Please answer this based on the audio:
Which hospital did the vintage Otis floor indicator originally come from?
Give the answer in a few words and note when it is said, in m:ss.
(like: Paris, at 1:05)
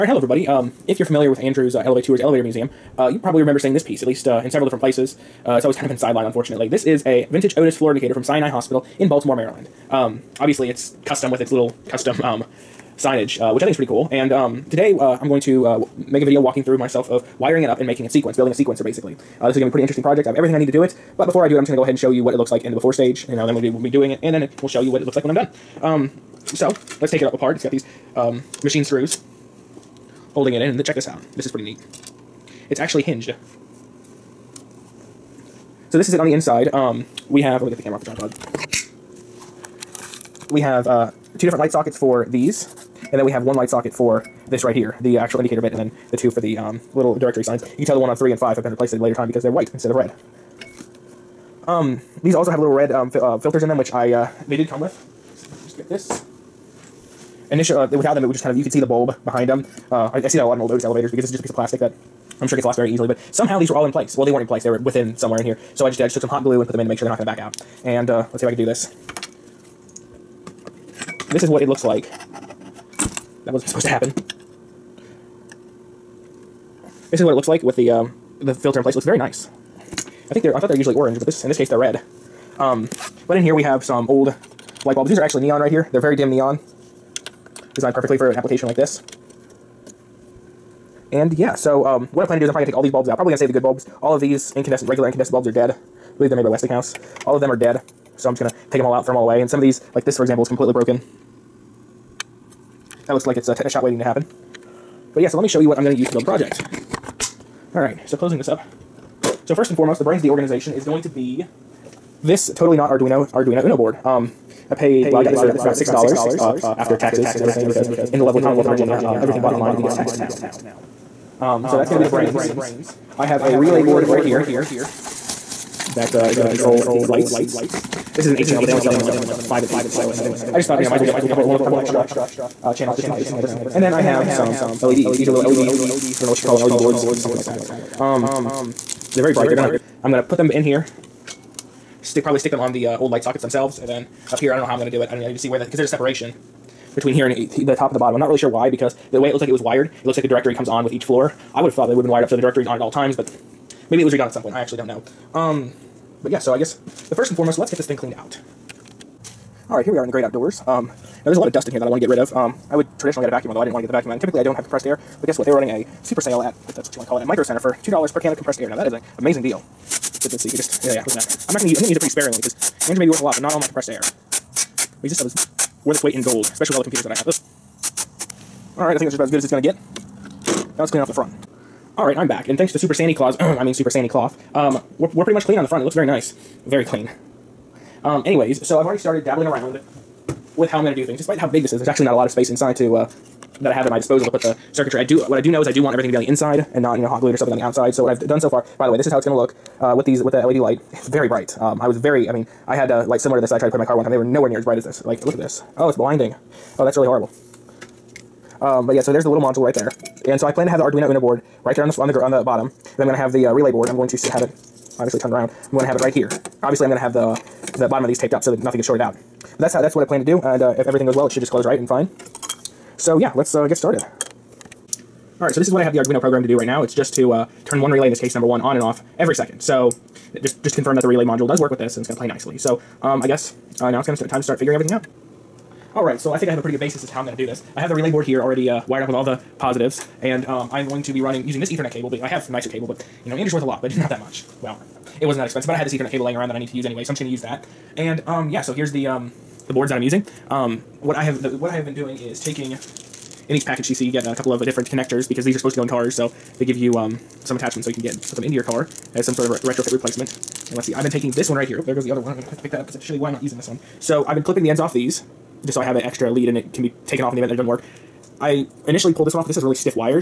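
Sinai Hospital, at 0:08.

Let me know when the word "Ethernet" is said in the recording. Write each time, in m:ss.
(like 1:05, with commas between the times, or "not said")
4:01, 4:05.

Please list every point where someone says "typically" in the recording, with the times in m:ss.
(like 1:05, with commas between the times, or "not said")
2:44.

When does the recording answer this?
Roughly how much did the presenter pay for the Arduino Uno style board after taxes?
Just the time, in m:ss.
1:55.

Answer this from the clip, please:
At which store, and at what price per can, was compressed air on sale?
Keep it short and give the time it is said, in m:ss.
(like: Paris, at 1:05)
Micro Center, $2, at 2:47.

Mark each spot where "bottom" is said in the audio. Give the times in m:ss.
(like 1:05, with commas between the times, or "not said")
2:27, 3:32, 3:37.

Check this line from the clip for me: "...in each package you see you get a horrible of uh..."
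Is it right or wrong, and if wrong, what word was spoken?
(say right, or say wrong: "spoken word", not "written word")
wrong: "couple", not "horrible".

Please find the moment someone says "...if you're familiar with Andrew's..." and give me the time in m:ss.
0:00.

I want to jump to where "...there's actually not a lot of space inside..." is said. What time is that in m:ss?
3:11.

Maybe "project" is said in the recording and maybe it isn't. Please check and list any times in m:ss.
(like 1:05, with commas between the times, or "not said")
0:20, 1:46.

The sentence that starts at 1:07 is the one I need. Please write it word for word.
And uh, let's see if I can do this.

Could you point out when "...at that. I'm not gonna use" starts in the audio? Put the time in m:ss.
2:51.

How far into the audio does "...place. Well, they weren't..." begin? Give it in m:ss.
1:03.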